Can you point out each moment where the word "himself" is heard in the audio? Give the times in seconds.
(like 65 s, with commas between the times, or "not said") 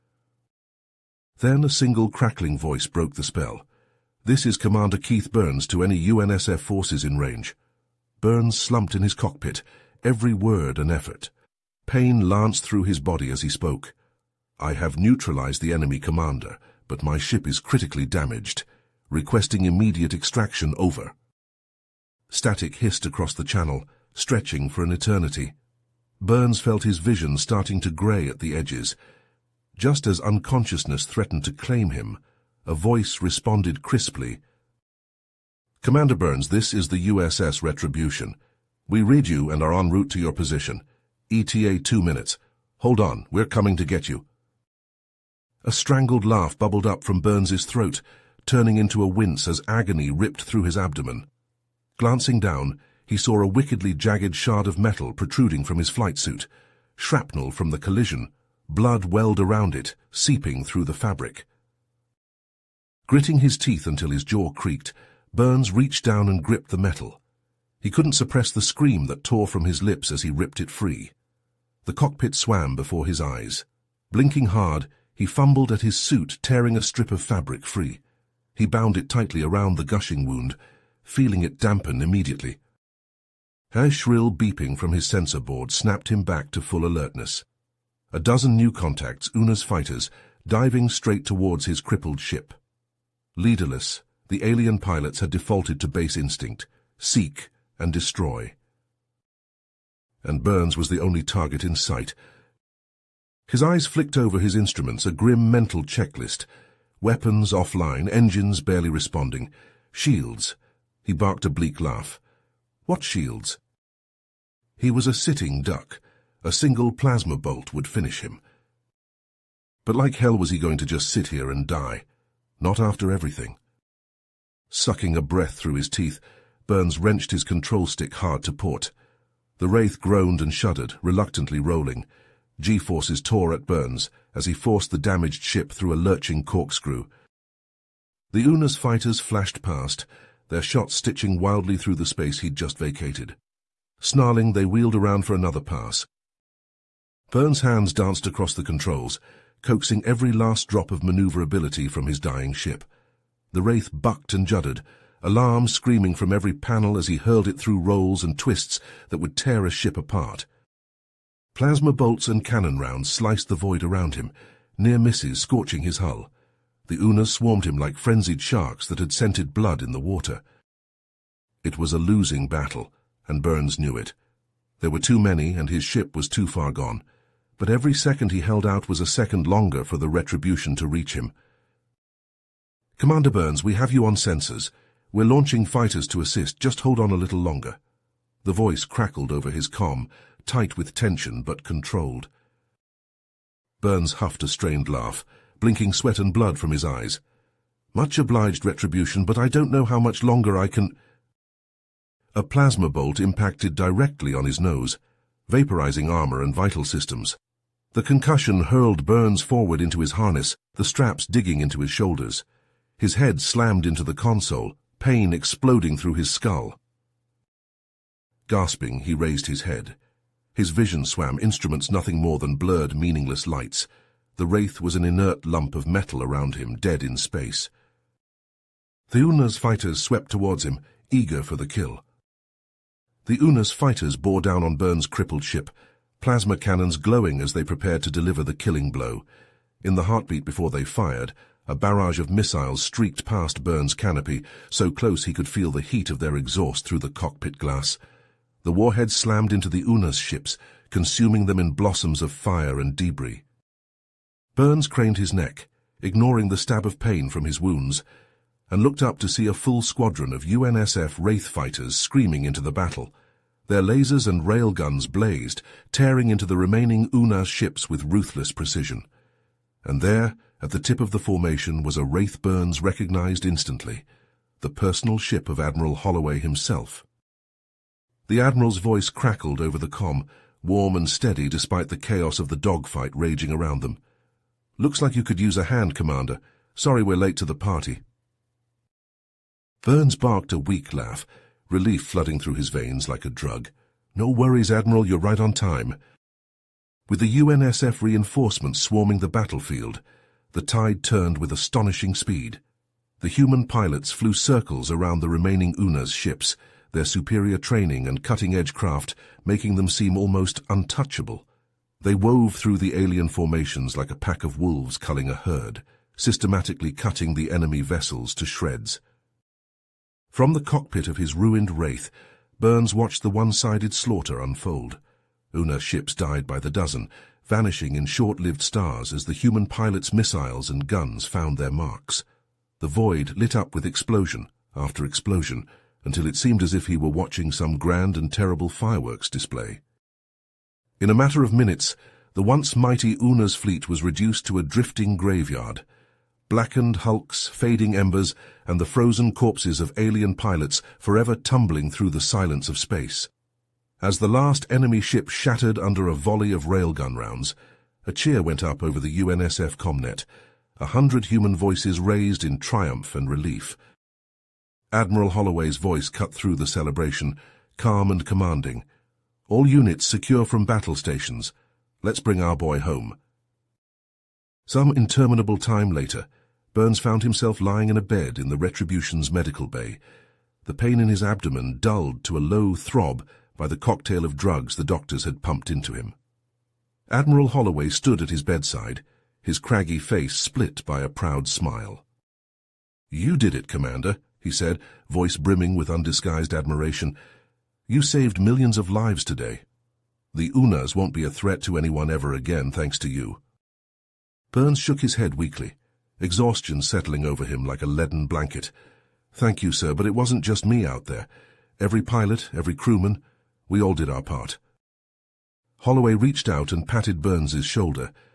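276 s, 377 s.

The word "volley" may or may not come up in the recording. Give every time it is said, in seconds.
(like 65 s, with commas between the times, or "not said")
356 s.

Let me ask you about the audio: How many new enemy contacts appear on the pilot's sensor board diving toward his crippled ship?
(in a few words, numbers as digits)
12.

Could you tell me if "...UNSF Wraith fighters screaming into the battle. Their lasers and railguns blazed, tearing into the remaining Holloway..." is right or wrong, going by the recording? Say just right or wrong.
wrong.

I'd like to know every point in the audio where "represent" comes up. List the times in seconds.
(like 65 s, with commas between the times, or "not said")
not said.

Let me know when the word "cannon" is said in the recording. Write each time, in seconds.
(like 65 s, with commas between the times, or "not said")
162 s, 236 s.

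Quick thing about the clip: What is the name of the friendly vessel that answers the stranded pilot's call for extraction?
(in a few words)
USS Retribution.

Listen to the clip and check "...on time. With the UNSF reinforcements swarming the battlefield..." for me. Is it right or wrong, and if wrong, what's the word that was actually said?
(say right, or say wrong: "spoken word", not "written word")
right.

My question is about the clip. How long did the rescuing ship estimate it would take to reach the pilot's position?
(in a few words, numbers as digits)
2 minutes.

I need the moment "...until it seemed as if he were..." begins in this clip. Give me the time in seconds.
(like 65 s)
336 s.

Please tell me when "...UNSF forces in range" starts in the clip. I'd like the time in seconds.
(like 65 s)
6 s.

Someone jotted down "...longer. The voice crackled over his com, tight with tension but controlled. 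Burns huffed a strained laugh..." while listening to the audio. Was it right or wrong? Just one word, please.
right.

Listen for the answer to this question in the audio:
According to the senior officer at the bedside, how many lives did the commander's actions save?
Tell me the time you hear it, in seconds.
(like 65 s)
398 s.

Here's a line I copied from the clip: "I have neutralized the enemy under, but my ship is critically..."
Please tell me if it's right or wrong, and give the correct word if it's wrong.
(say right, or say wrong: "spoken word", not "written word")
wrong: "commander", not "under".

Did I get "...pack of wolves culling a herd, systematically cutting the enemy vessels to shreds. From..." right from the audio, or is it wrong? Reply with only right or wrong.
right.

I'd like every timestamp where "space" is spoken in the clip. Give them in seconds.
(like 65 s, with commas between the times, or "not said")
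142 s, 227 s, 352 s.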